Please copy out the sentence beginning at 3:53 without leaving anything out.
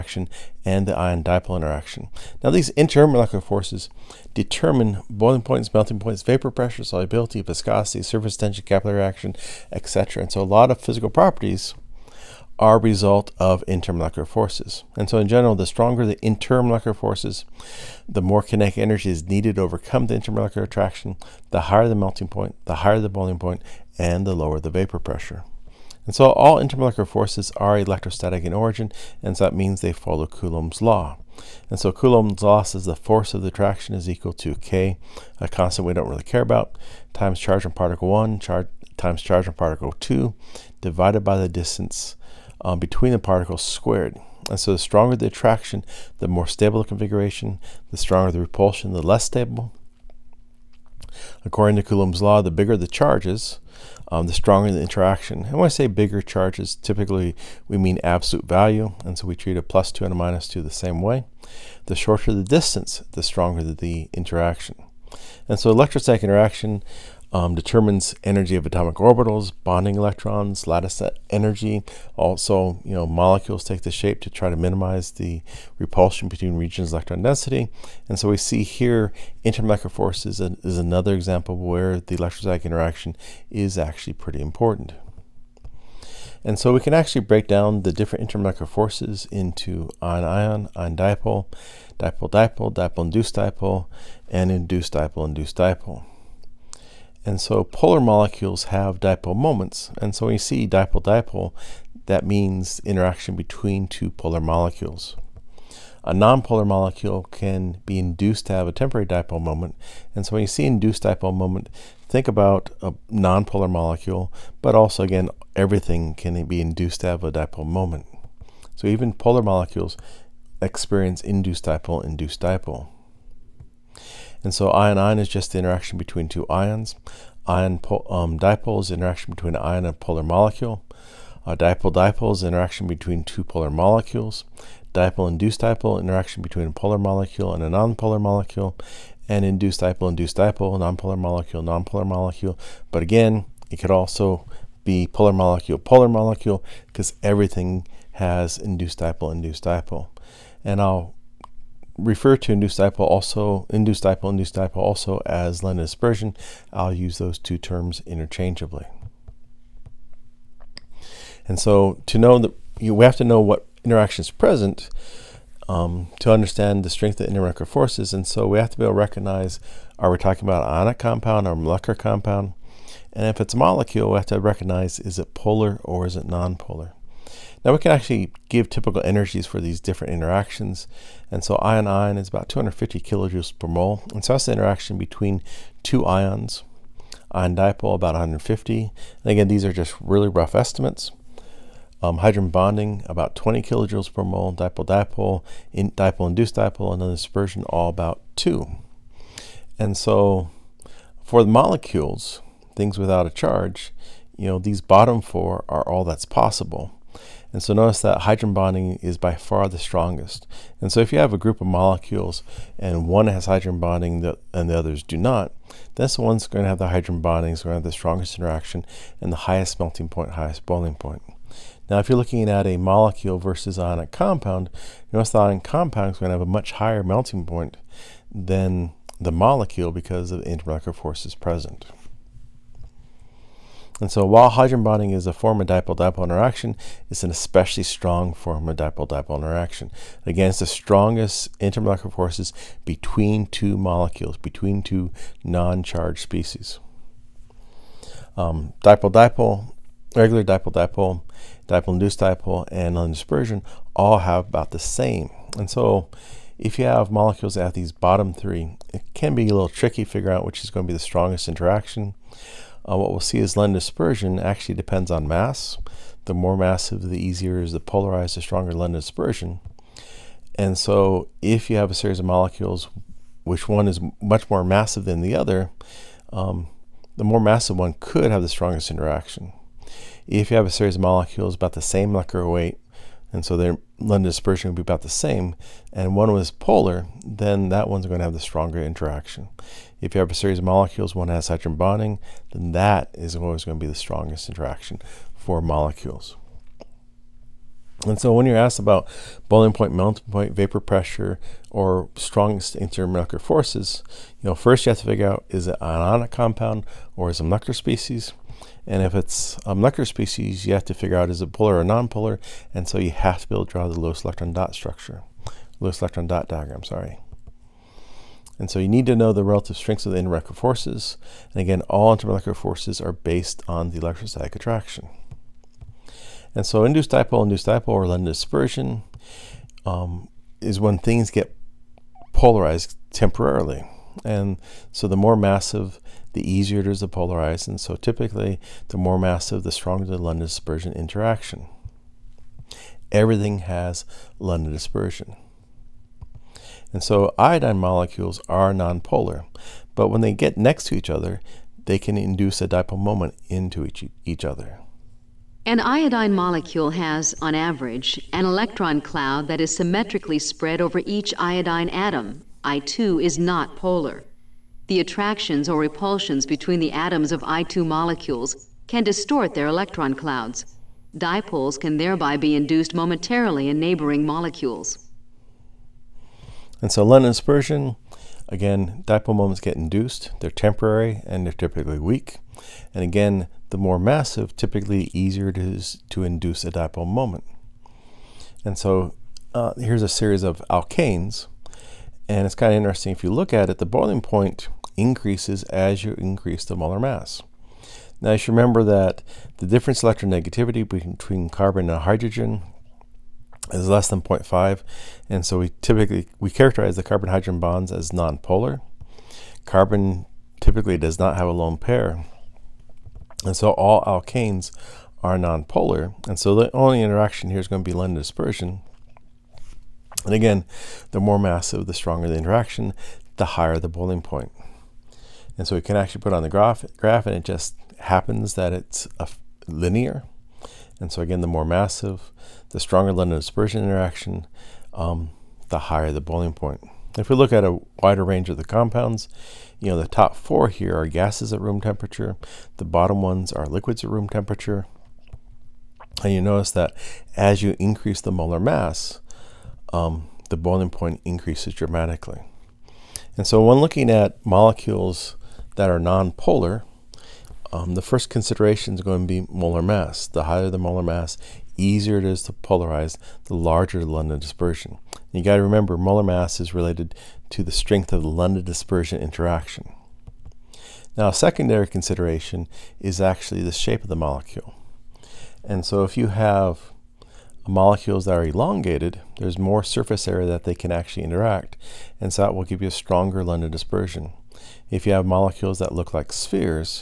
And so while hydrogen bonding is a form of dipole-dipole interaction, it's an especially strong form of dipole-dipole interaction.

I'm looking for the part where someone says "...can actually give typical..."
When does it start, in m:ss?
2:57.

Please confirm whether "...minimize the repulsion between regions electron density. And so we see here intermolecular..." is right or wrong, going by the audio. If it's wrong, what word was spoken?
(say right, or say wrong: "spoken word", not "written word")
right.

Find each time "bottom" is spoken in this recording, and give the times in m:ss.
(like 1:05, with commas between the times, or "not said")
3:24, 4:17, 7:22.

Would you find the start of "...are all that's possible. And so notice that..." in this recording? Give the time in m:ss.
3:25.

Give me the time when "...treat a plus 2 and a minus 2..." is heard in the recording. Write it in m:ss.
0:59.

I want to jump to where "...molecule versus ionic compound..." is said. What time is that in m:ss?
3:42.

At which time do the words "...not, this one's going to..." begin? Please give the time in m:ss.
3:35.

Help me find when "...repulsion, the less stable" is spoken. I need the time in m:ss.
0:48.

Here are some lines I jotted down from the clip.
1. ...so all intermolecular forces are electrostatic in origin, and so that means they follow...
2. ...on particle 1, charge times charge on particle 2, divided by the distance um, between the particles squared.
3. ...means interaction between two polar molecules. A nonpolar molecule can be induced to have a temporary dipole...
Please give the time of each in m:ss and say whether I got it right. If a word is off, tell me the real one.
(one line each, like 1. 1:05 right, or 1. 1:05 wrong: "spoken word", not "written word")
1. 0:26 right
2. 0:37 right
3. 1:42 right.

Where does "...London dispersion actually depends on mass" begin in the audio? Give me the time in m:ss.
4:23.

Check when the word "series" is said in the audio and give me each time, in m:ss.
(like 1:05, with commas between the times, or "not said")
4:31, 4:40, 4:50, 6:30.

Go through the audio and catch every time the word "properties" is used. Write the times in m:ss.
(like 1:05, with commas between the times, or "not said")
0:11.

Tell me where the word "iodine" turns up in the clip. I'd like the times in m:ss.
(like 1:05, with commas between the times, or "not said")
5:47, 5:55, 6:01.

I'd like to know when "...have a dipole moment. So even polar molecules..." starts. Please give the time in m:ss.
1:57.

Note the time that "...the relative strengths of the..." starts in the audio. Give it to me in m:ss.
5:19.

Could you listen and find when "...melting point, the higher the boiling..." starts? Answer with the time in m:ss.
0:21.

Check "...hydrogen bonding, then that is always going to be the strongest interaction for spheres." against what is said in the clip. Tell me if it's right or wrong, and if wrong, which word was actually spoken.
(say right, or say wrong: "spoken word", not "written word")
wrong: "molecules", not "spheres".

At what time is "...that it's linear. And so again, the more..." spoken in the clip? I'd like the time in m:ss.
7:08.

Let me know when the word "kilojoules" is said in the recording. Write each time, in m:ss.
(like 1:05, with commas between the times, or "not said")
3:02, 3:13.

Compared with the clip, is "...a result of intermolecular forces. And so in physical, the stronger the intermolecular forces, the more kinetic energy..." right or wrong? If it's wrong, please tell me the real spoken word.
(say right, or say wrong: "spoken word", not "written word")
wrong: "general", not "physical".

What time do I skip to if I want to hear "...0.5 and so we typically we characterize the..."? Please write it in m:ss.
6:44.